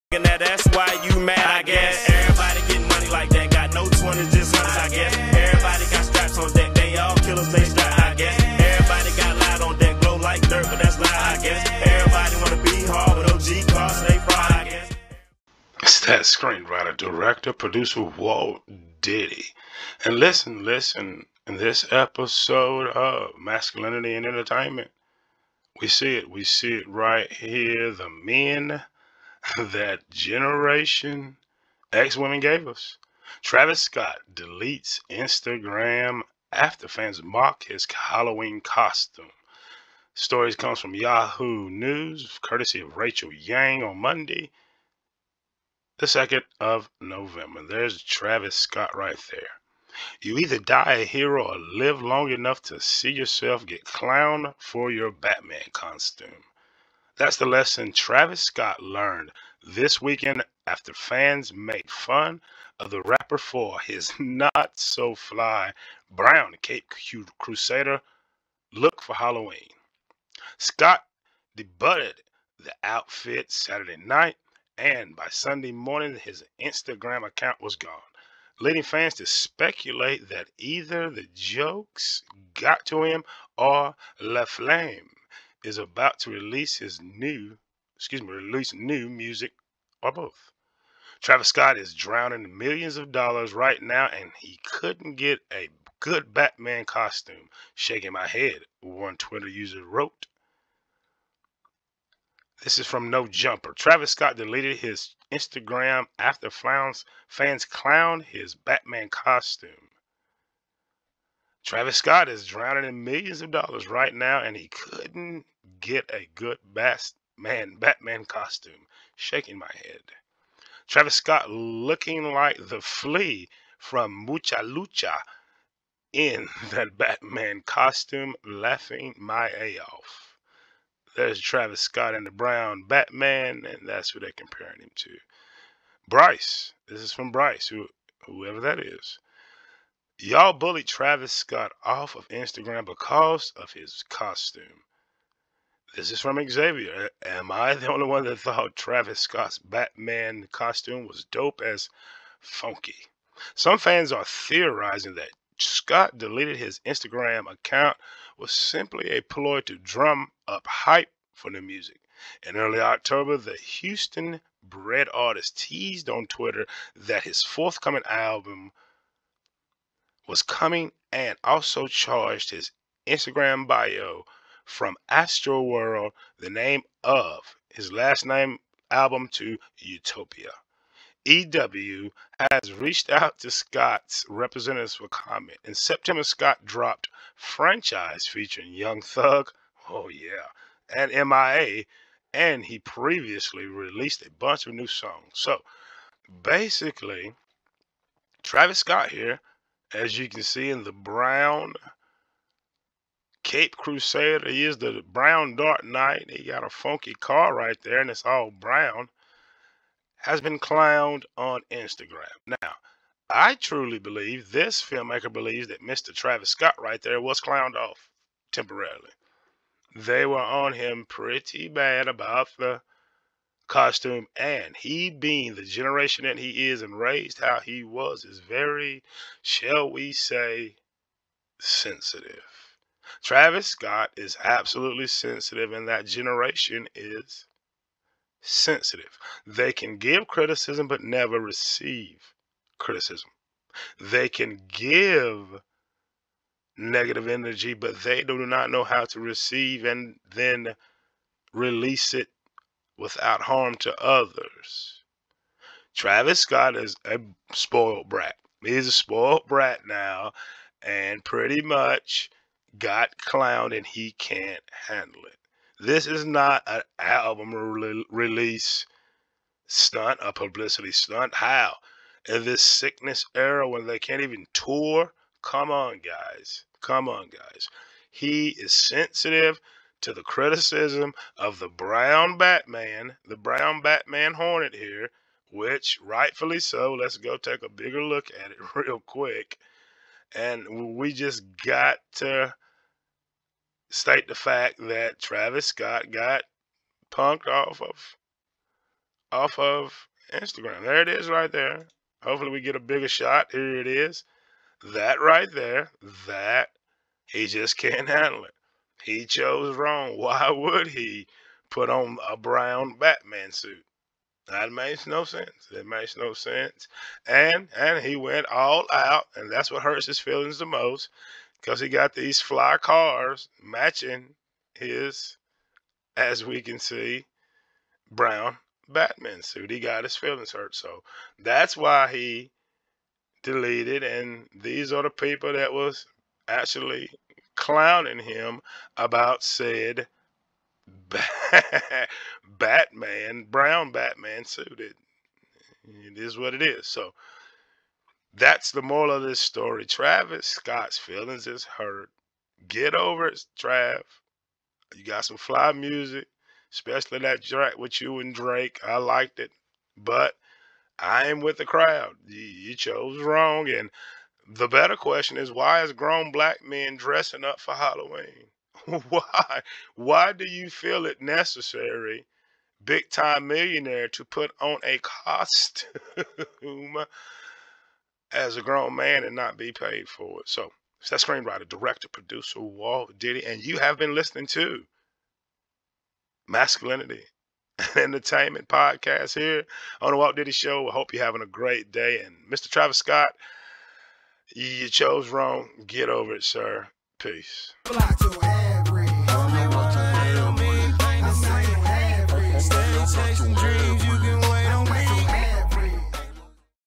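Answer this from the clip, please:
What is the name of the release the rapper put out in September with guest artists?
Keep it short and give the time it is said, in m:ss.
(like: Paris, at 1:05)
Franchise, at 3:07.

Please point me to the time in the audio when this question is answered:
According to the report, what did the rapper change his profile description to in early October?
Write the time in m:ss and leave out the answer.
2:59.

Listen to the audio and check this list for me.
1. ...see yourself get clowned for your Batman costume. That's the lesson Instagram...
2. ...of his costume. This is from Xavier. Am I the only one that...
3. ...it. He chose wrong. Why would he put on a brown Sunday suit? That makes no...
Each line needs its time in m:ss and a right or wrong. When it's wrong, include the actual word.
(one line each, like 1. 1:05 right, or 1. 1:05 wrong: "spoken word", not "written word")
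1. 0:52 wrong: "Travis", not "Instagram"
2. 2:23 right
3. 5:08 wrong: "Batman", not "Sunday".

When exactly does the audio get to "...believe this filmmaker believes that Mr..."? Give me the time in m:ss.
3:33.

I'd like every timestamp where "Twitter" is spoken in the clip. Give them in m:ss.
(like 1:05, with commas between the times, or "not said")
1:39, 2:46.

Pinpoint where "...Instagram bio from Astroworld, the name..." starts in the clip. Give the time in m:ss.
2:53.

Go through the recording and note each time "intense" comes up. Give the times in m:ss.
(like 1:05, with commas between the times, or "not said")
not said.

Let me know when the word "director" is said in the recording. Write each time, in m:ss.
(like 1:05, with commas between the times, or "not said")
0:16, 6:21.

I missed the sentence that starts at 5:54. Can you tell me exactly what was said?
You got some fly music, especially that track with you and Drake.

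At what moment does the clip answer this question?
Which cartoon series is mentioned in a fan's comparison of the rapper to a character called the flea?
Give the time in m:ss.
2:04.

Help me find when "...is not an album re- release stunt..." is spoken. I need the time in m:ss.
4:26.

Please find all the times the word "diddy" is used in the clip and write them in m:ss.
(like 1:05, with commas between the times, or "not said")
0:18, 6:23, 6:30.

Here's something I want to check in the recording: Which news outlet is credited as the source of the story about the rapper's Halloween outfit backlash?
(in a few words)
Yahoo News.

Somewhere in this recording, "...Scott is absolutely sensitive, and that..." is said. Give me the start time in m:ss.
3:53.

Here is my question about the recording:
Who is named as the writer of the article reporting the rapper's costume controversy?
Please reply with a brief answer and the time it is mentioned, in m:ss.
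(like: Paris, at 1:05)
Rachel Yang, at 0:42.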